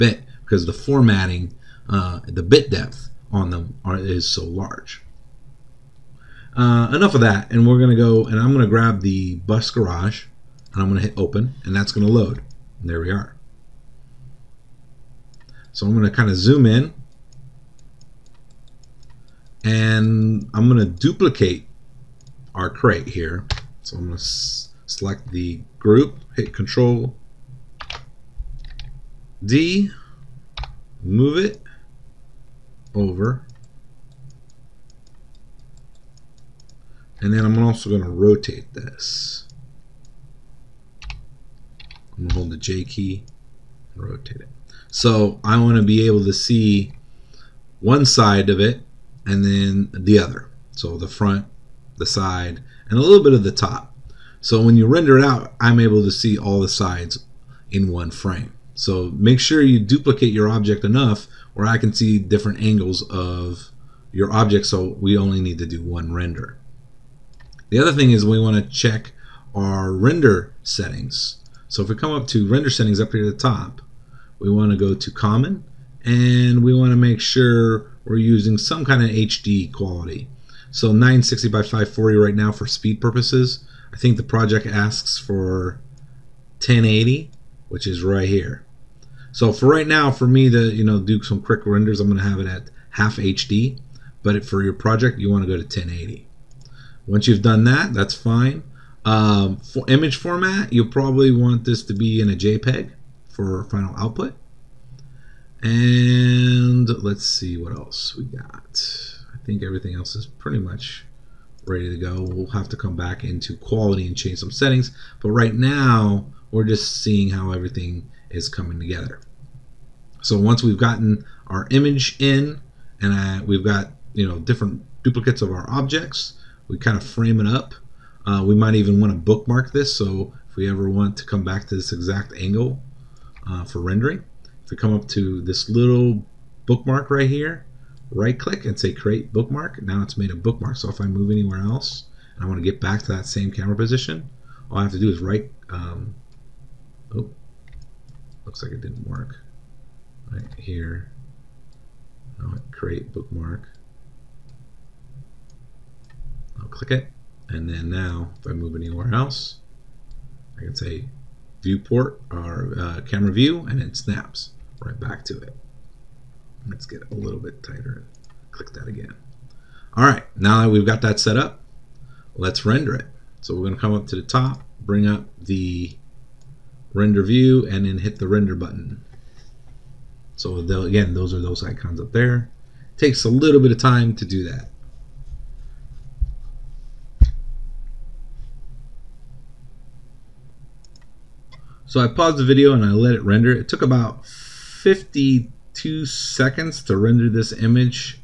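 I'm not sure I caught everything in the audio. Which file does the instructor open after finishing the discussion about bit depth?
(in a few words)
bus garage.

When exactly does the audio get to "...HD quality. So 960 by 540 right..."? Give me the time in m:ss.
1:19.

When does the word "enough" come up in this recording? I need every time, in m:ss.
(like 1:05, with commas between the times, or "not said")
0:06, 1:00.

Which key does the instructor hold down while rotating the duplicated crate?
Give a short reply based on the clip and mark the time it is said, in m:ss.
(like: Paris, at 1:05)
J, at 0:42.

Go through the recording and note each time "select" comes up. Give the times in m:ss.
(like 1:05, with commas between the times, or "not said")
0:24.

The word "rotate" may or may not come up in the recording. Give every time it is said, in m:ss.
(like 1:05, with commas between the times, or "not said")
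0:38, 0:44.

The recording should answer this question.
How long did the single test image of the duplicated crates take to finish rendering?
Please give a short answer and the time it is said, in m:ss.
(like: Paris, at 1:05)
52 seconds, at 3:14.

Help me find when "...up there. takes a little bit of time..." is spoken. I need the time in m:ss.
3:01.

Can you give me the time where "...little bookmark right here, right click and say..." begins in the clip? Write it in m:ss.
2:15.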